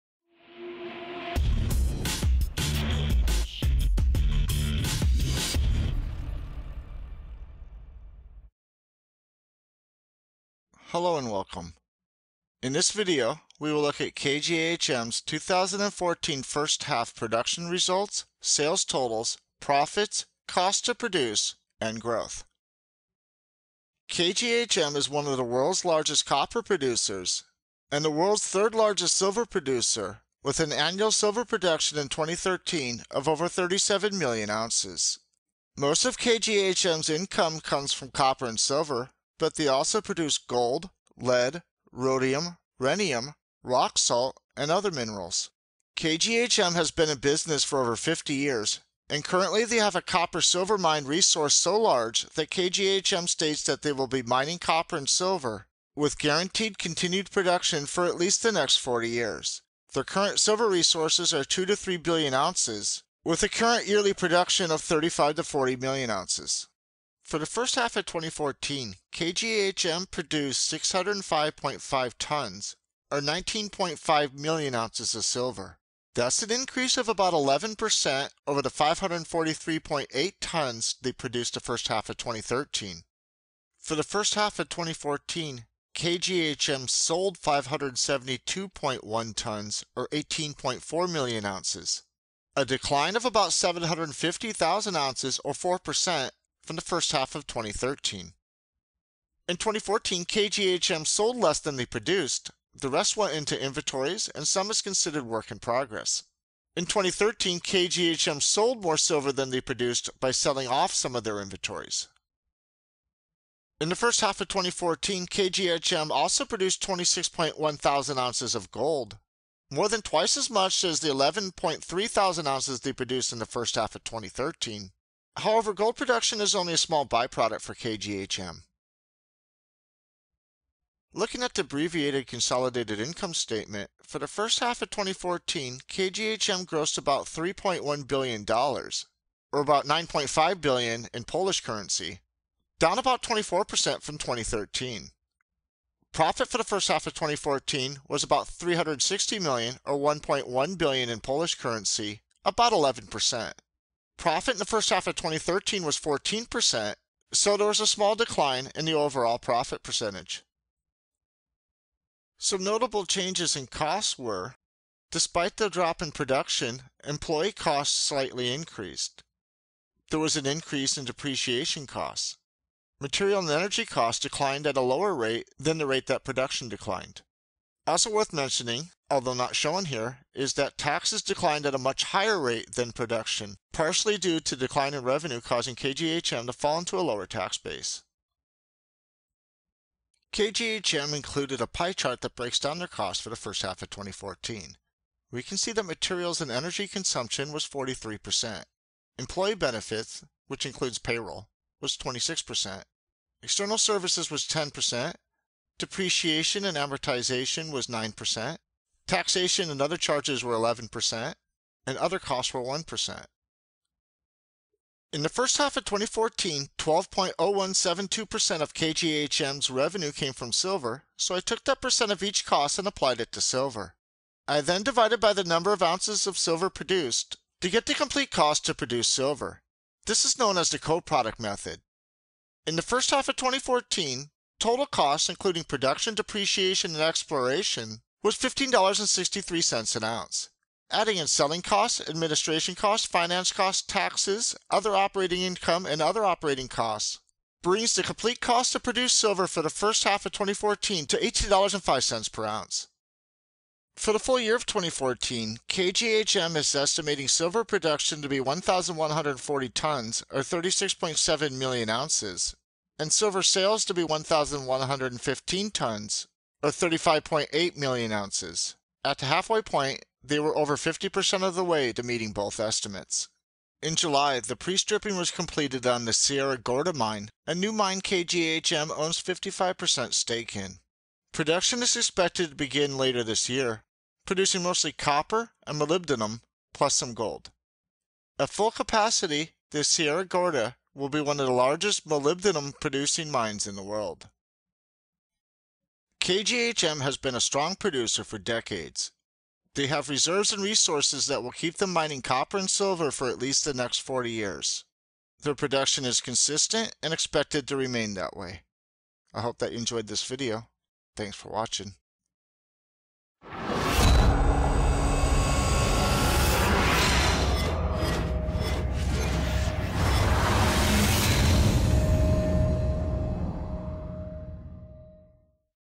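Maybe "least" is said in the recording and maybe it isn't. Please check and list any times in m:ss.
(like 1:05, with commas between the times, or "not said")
0:58, 5:03.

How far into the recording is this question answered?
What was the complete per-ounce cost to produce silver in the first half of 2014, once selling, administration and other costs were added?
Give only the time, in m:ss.
4:11.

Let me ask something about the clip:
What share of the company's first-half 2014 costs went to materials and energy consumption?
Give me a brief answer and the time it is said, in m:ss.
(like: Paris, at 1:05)
43%, at 3:17.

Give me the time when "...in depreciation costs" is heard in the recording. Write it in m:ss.
2:50.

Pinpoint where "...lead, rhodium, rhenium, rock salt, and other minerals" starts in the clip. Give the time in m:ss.
0:41.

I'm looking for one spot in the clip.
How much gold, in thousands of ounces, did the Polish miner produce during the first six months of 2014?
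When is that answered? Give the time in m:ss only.
1:56.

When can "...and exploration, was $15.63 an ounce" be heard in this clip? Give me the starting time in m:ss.
3:56.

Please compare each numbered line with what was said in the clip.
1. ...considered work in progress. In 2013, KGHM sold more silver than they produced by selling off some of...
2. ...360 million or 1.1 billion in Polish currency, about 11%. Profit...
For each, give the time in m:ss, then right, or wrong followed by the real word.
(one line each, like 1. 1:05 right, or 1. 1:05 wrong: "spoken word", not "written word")
1. 1:44 right
2. 2:28 right.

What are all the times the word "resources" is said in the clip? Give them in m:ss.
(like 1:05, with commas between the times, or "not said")
0:51, 1:00, 5:00.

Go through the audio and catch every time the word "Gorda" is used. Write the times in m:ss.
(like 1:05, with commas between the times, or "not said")
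4:36, 4:50.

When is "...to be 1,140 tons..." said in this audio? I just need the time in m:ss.
4:18.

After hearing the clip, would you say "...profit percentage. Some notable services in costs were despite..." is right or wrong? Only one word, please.
wrong.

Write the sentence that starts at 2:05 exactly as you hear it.
However, gold production is only a small byproduct for KGHM.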